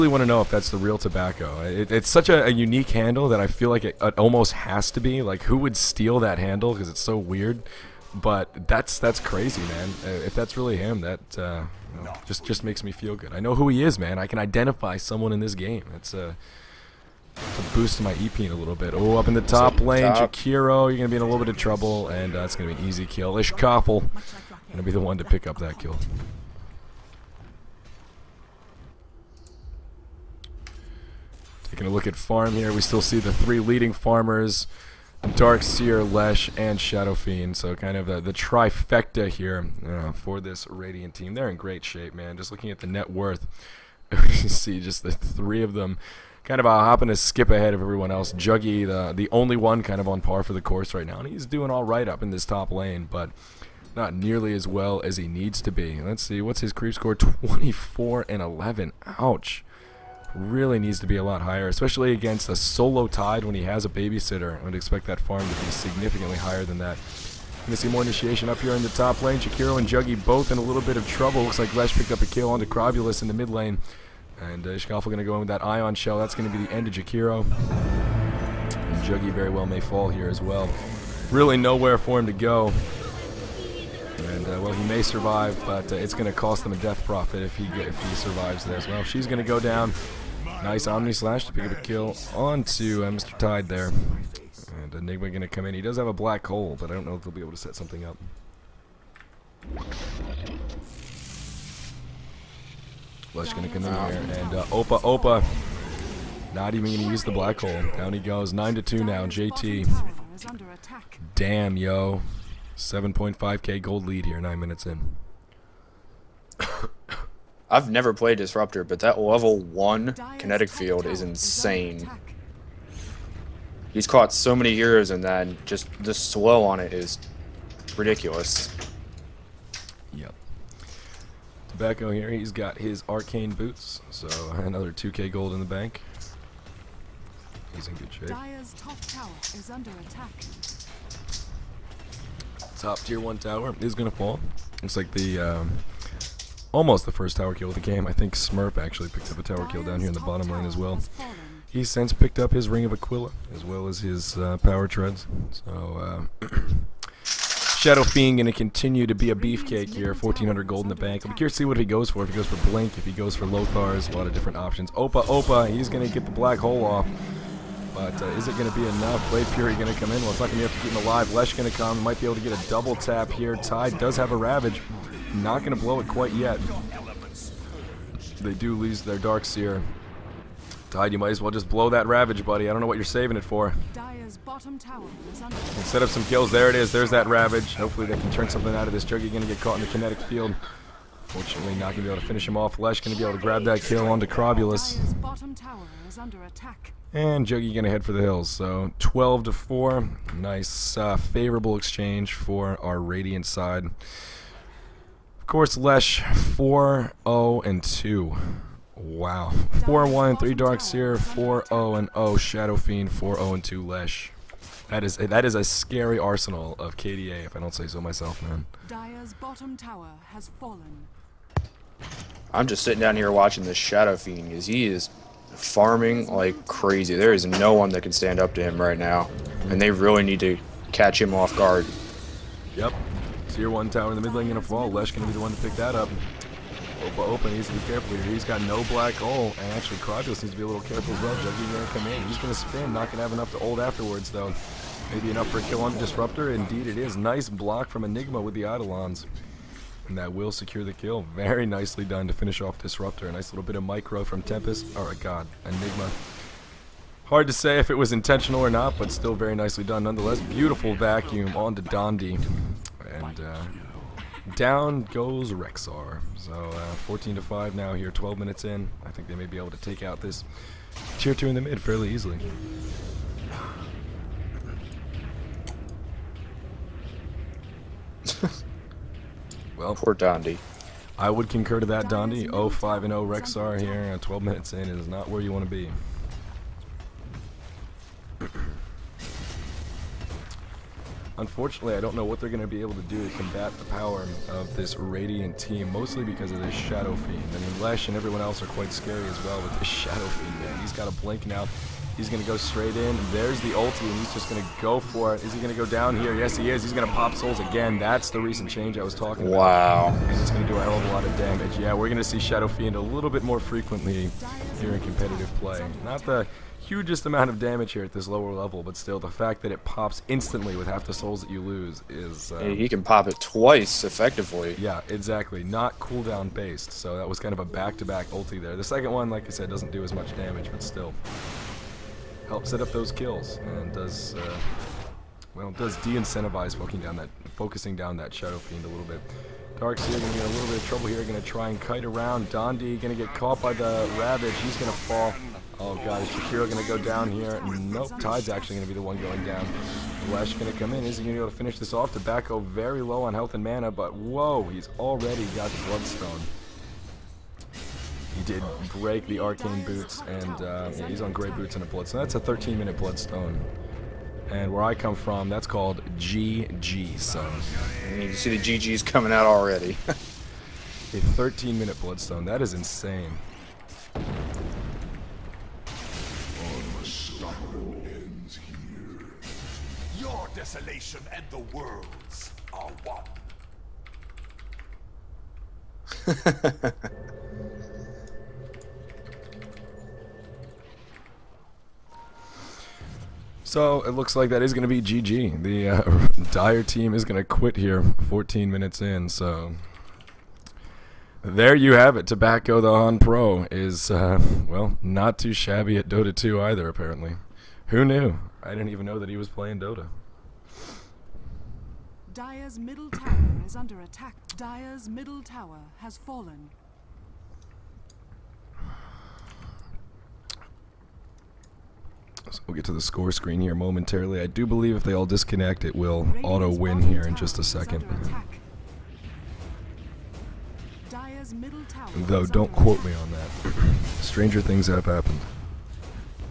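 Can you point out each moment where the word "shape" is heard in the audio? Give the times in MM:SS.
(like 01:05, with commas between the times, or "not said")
00:41, 02:18.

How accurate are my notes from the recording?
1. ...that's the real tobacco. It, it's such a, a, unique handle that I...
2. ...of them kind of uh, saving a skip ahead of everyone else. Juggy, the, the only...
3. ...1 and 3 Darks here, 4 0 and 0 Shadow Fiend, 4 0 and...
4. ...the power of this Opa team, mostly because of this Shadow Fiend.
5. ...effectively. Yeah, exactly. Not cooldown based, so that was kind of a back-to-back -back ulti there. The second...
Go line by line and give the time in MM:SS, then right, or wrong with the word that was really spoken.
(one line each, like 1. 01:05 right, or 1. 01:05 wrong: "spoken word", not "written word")
1. 00:00 right
2. 00:45 wrong: "hopping", not "saving"
3. 03:30 right
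4. 04:53 wrong: "Radiant", not "Opa"
5. 05:24 right.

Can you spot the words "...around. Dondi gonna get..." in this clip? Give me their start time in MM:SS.
05:42.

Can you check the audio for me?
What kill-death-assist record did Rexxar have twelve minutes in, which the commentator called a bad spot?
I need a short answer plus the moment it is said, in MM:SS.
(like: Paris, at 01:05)
0/5/0, at 04:42.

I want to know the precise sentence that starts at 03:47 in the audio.
There is no one that can stand up to him right now, and they really need to catch him off guard.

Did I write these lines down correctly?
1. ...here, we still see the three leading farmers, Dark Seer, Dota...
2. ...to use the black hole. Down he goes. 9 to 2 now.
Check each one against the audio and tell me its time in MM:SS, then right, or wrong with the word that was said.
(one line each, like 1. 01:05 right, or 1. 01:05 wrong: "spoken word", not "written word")
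1. 00:32 wrong: "Lesh", not "Dota"
2. 01:47 right.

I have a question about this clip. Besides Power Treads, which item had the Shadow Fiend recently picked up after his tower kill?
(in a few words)
Ring of Aquila.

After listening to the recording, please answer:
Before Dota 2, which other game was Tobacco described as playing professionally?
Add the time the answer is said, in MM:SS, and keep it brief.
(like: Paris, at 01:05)
HoN, at 06:42.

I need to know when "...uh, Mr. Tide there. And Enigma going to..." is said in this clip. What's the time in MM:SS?
01:33.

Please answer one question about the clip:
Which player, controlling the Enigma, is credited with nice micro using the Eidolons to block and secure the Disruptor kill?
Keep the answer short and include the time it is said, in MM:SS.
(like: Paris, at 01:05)
Tempest, at 04:14.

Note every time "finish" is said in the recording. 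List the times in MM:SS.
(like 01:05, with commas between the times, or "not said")
03:12, 04:12, 05:51.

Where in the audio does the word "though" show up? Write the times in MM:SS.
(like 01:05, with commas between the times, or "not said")
04:04, 07:12.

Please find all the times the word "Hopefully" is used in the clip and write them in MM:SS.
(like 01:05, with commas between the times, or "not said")
03:07.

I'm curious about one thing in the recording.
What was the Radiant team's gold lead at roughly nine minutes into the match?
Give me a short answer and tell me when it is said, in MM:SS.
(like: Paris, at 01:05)
7.5k, at 01:52.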